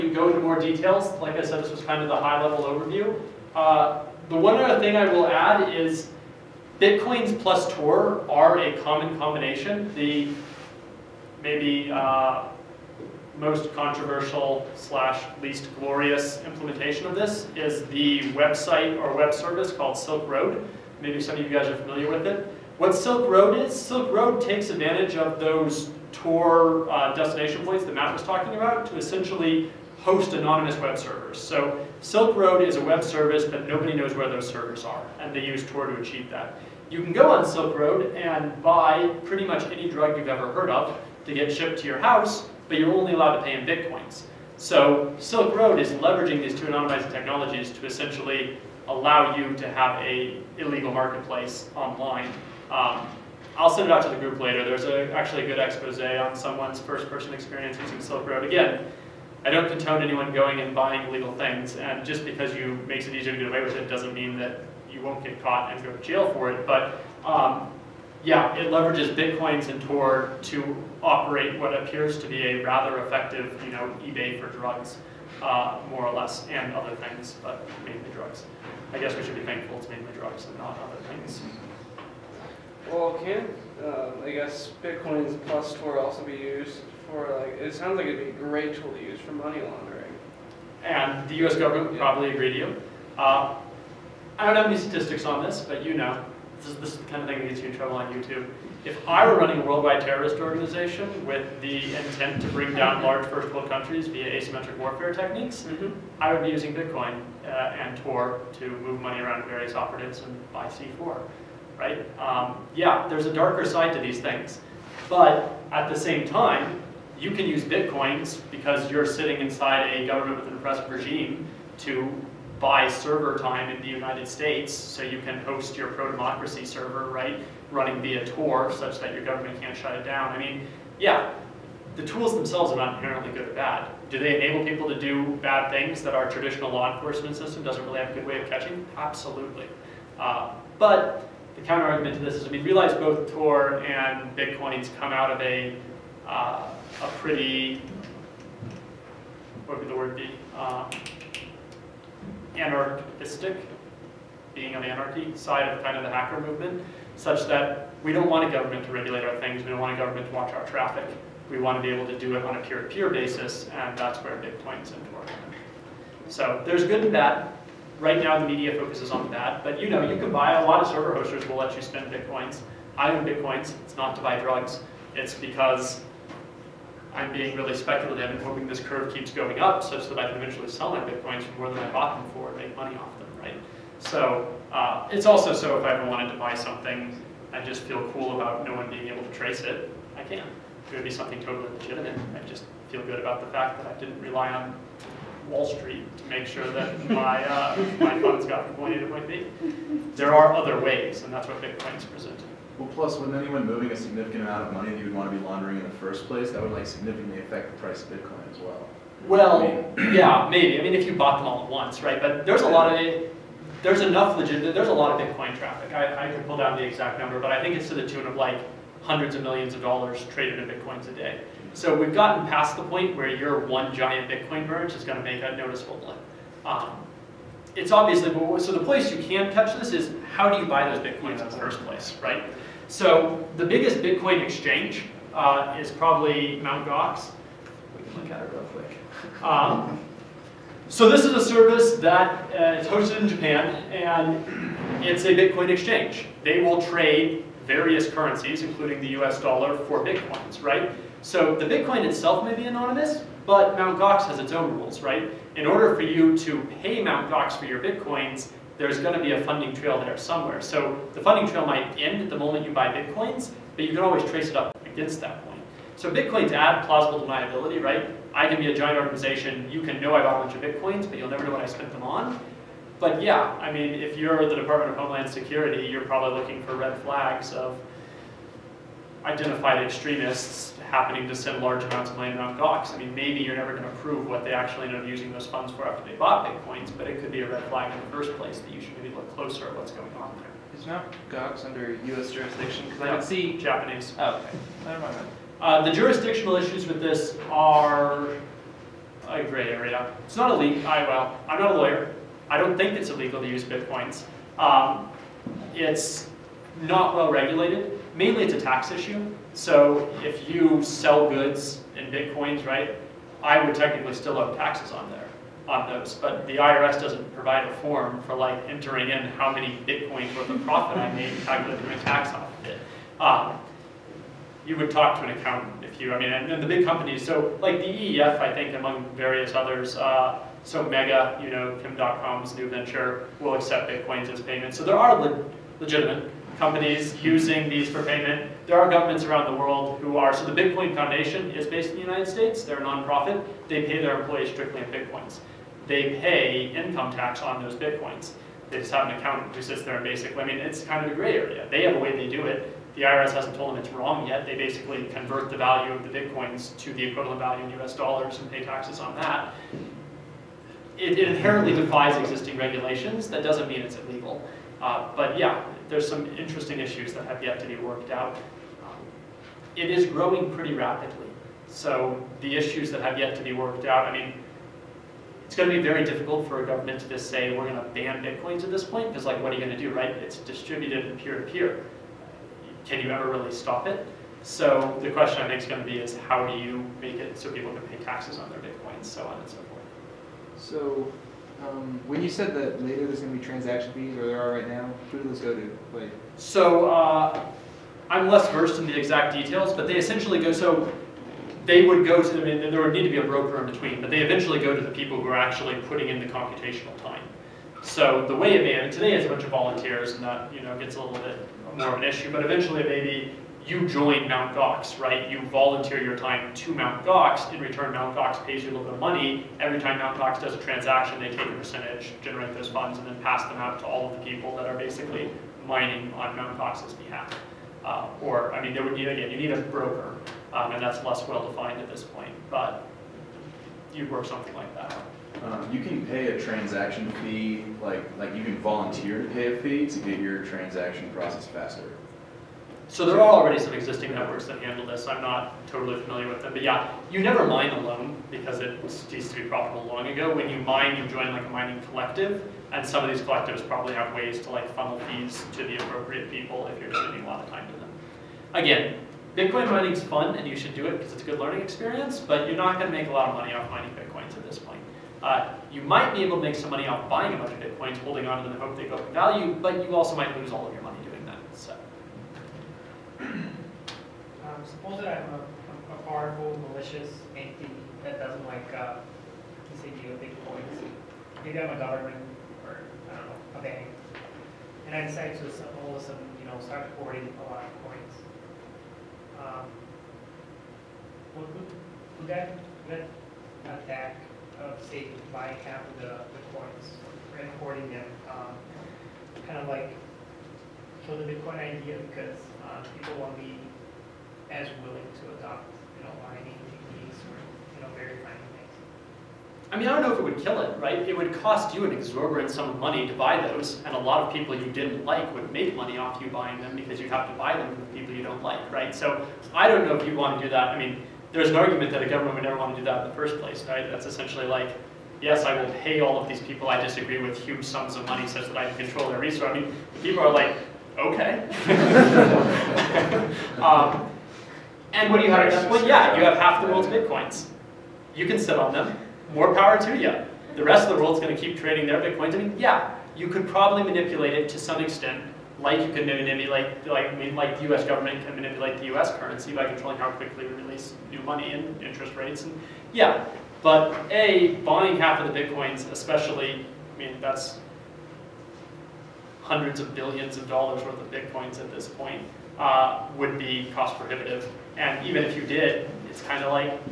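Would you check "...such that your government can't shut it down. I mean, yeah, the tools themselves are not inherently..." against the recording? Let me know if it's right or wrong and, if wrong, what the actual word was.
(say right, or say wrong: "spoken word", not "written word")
right.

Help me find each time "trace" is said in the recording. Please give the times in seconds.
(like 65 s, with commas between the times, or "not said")
189 s, 264 s.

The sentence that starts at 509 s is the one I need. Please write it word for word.
I mean, I don't know if it would kill it, right?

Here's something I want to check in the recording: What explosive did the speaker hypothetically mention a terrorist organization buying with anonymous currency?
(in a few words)
C4.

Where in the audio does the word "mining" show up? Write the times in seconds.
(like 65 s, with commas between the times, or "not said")
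425 s, 451 s, 463 s, 506 s.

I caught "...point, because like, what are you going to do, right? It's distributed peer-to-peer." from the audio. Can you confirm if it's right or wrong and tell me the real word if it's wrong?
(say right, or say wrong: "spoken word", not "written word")
right.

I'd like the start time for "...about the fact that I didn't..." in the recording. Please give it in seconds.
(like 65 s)
193 s.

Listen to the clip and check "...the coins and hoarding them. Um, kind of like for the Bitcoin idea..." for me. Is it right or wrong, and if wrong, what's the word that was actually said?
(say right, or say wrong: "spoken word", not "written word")
right.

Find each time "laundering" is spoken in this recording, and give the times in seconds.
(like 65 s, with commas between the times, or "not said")
89 s, 205 s.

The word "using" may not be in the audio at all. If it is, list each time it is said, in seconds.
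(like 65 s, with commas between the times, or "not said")
57 s, 106 s, 285 s, 337 s.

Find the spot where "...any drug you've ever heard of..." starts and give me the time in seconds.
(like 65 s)
39 s.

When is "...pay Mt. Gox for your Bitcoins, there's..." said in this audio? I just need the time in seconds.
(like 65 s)
256 s.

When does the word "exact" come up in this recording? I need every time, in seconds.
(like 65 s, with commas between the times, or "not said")
216 s, 398 s.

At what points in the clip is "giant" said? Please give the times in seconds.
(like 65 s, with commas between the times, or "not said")
223 s, 268 s.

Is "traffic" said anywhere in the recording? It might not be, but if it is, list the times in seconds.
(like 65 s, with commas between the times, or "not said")
160 s, 215 s.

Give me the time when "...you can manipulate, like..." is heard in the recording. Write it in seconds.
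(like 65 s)
545 s.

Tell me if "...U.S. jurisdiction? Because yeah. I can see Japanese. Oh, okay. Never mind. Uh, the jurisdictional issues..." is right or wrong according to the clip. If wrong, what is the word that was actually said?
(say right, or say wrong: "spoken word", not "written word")
right.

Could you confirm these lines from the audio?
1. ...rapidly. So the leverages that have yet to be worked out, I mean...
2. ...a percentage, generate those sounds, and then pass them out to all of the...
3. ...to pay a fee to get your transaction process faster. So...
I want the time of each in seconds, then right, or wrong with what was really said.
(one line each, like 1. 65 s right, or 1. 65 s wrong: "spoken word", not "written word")
1. 370 s wrong: "issues", not "leverages"
2. 421 s wrong: "funds", not "sounds"
3. 439 s right.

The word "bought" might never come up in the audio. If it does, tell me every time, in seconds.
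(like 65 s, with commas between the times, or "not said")
181 s, 211 s, 270 s, 286 s.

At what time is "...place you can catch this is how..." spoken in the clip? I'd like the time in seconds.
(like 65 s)
228 s.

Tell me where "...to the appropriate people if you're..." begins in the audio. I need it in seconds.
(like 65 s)
455 s.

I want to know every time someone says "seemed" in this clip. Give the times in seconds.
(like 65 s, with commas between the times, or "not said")
not said.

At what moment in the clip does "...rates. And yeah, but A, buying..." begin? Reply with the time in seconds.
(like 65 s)
552 s.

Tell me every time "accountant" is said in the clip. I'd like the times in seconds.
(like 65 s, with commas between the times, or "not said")
325 s, 349 s.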